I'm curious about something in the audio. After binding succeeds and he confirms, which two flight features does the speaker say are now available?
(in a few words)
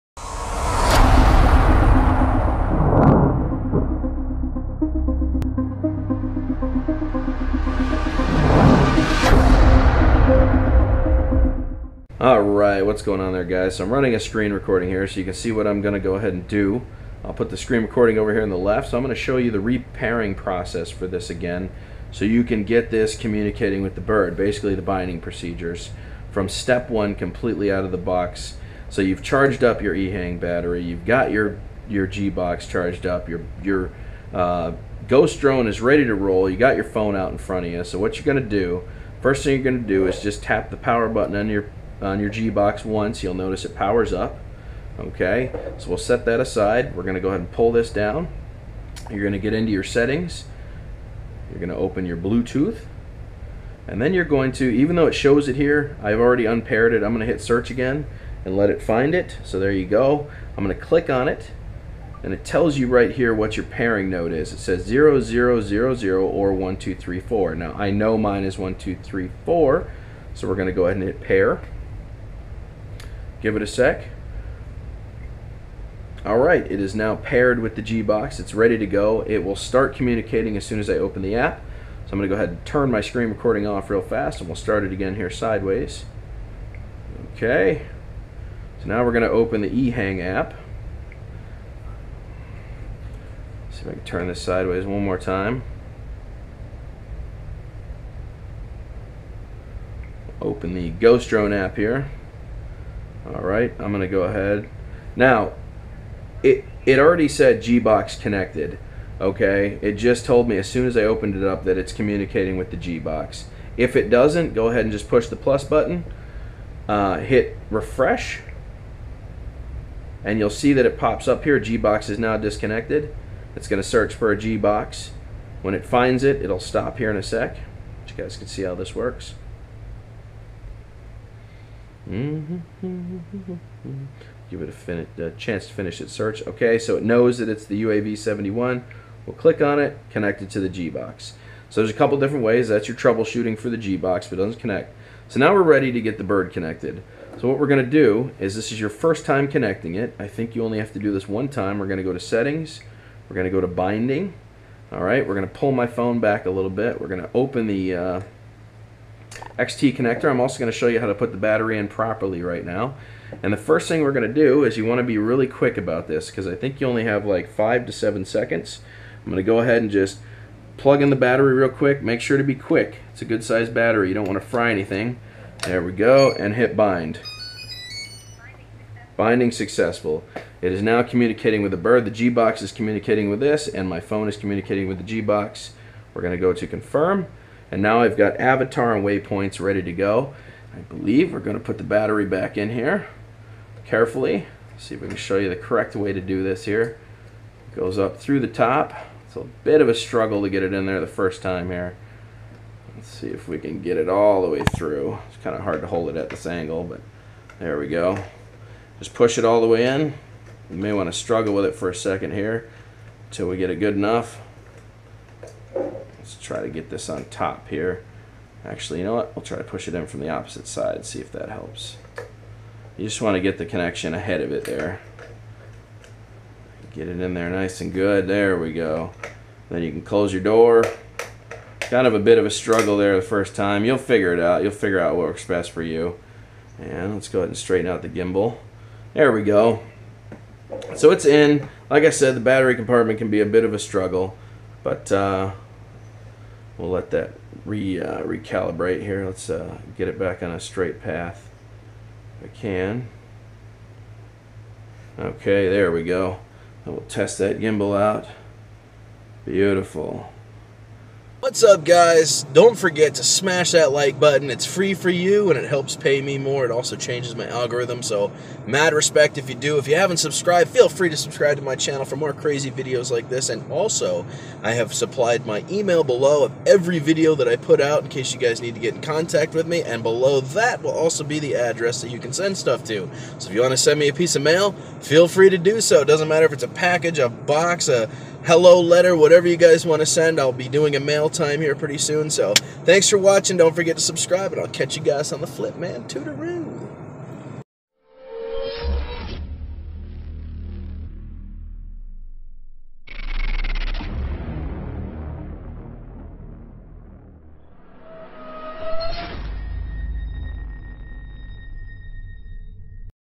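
Avatar and waypoints.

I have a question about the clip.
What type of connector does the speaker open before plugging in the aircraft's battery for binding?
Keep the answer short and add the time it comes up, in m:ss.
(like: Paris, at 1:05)
XT connector, at 2:39.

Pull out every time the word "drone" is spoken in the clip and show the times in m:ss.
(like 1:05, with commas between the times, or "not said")
0:35, 1:41.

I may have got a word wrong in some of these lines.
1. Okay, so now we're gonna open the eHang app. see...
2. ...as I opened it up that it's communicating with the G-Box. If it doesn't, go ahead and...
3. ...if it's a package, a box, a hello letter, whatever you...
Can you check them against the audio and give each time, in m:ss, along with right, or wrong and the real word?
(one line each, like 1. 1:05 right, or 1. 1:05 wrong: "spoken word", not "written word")
1. 1:27 right
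2. 1:50 right
3. 4:46 right.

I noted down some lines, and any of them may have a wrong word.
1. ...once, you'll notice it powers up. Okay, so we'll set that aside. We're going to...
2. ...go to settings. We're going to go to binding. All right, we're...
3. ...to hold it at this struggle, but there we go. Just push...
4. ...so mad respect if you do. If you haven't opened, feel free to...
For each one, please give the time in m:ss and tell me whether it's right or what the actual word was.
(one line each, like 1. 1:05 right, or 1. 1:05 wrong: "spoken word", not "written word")
1. 0:42 right
2. 2:32 right
3. 3:25 wrong: "angle", not "struggle"
4. 4:28 wrong: "subscribed", not "opened".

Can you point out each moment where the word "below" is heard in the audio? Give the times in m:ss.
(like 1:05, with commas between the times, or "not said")
4:36, 4:40.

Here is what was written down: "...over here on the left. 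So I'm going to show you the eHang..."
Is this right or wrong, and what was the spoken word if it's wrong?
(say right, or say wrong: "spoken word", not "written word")
wrong: "repairing", not "eHang".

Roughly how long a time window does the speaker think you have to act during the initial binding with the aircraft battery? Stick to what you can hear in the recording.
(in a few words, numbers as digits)
5 to 7 seconds.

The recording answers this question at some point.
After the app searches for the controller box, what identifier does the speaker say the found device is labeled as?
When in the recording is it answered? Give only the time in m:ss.
2:17.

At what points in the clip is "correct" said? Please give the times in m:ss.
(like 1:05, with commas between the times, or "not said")
3:15.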